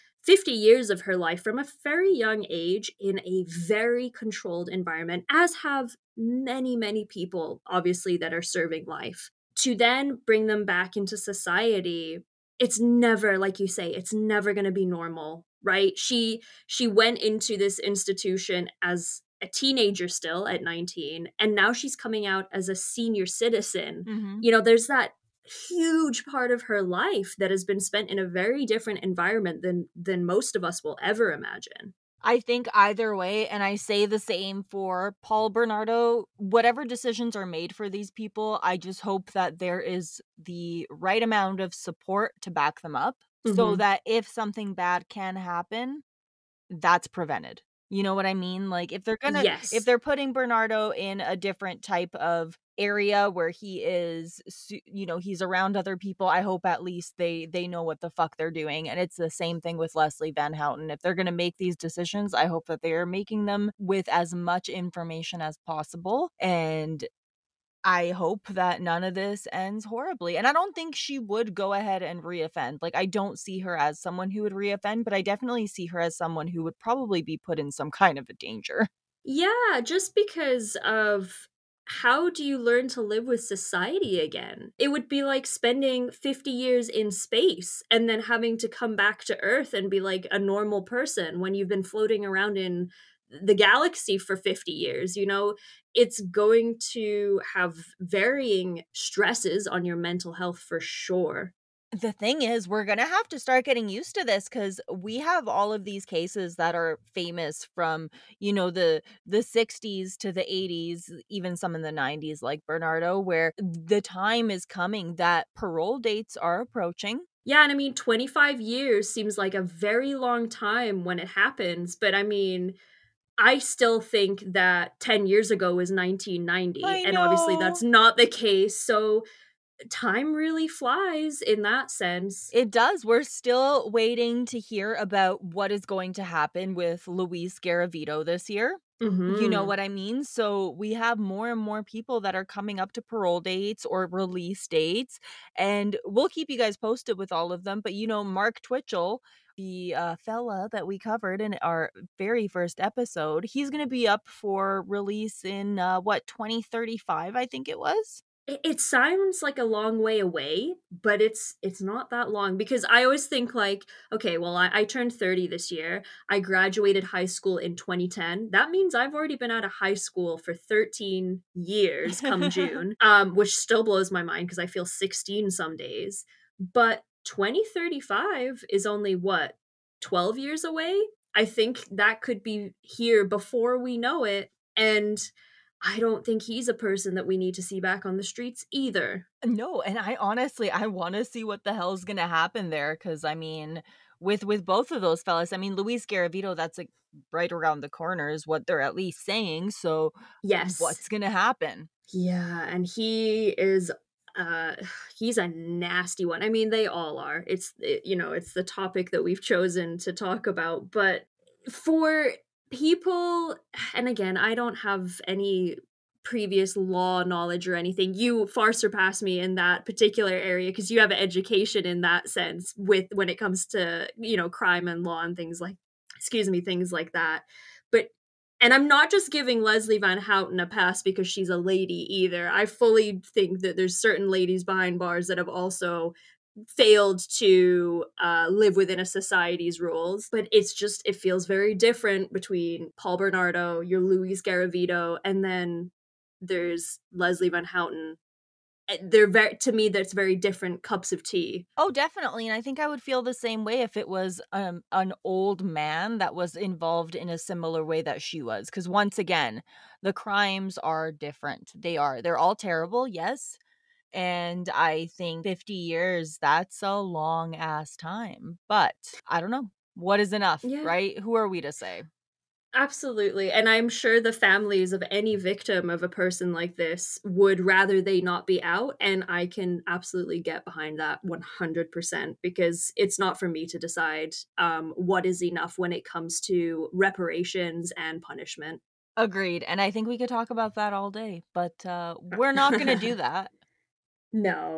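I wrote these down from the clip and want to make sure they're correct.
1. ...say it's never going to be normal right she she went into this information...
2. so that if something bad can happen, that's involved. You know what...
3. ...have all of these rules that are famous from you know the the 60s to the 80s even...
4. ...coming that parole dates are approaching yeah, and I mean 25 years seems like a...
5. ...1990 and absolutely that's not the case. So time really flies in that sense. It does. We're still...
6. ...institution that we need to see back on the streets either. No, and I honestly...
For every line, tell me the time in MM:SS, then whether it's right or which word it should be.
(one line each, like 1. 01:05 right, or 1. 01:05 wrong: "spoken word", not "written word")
1. 00:13 wrong: "institution", not "information"
2. 00:43 wrong: "prevented", not "involved"
3. 01:45 wrong: "cases", not "rules"
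4. 01:54 right
5. 02:05 wrong: "obviously", not "absolutely"
6. 03:06 wrong: "person", not "institution".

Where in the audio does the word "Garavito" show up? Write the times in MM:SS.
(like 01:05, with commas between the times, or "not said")
02:17, 03:16, 04:04.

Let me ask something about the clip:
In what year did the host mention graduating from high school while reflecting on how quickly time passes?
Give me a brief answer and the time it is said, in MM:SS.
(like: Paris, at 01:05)
2010, at 02:47.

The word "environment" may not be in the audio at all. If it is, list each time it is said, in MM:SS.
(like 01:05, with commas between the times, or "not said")
00:04, 00:29.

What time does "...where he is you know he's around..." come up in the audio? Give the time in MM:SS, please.
00:53.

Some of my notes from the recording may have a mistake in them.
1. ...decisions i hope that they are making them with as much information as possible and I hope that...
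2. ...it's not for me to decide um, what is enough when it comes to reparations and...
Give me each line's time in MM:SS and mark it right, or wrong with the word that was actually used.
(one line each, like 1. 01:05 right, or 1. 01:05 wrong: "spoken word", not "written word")
1. 01:01 right
2. 04:42 right.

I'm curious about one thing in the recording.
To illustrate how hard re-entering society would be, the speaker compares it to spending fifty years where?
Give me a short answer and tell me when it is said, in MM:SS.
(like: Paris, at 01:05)
In space, at 01:26.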